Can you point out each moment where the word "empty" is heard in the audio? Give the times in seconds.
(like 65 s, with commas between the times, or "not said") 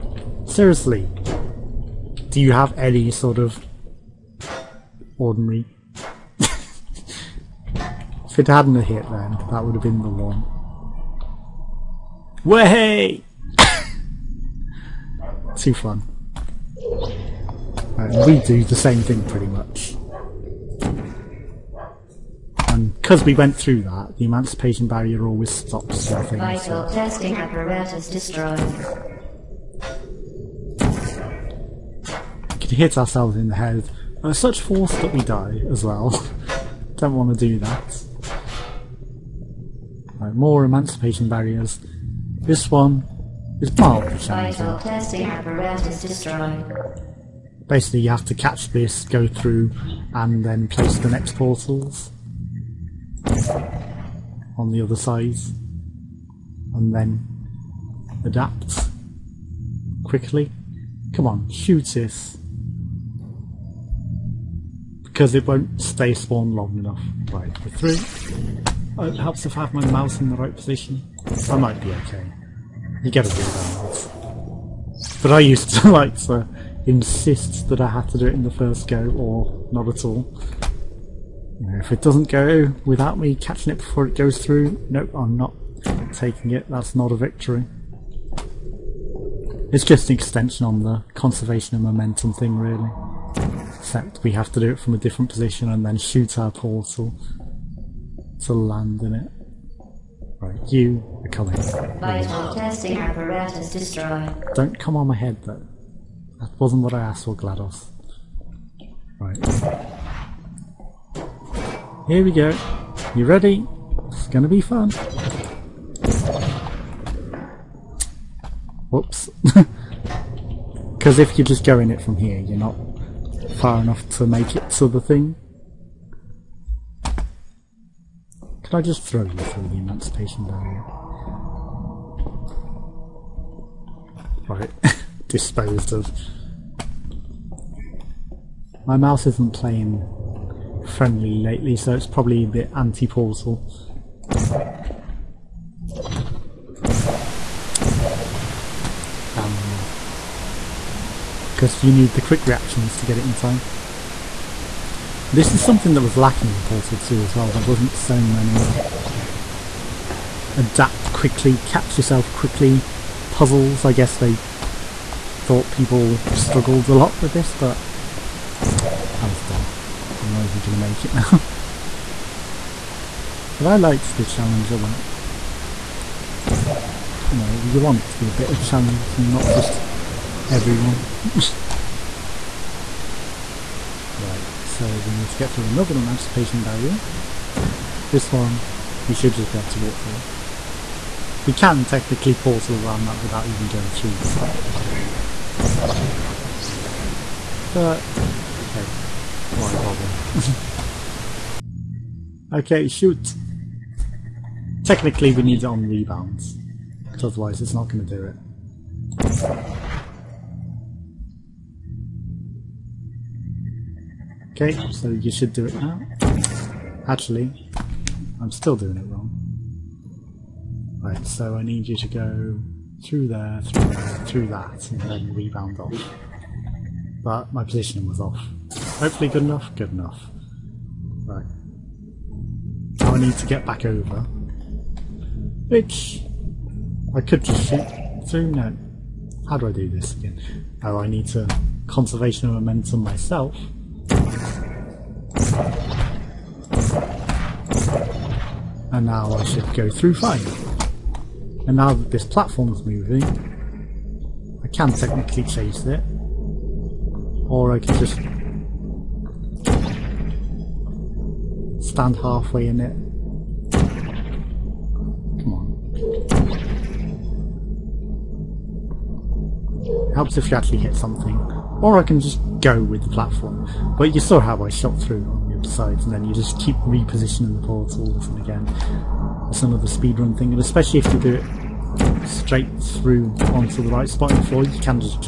not said.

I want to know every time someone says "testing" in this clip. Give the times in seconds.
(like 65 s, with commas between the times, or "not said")
26 s, 102 s.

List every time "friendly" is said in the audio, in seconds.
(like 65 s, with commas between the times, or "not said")
140 s.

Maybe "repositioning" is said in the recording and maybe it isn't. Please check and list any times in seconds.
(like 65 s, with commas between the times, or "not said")
276 s.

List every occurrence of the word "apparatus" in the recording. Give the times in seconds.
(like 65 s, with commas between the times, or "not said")
27 s, 102 s.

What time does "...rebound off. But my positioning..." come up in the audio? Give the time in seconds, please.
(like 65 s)
225 s.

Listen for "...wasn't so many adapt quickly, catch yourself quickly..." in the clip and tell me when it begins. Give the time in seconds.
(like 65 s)
157 s.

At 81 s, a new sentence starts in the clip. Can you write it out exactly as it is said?
If it doesn't go without me catching it before it goes through, nope, I'm not taking it.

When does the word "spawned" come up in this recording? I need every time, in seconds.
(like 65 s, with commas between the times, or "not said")
66 s.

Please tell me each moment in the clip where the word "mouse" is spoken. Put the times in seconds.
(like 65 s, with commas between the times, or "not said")
69 s, 138 s.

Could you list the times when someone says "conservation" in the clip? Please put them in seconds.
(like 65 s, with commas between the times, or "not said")
91 s, 241 s.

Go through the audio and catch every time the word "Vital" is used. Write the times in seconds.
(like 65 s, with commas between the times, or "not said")
26 s, 44 s, 101 s.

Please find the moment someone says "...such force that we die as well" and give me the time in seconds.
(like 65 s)
34 s.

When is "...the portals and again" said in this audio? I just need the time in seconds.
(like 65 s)
277 s.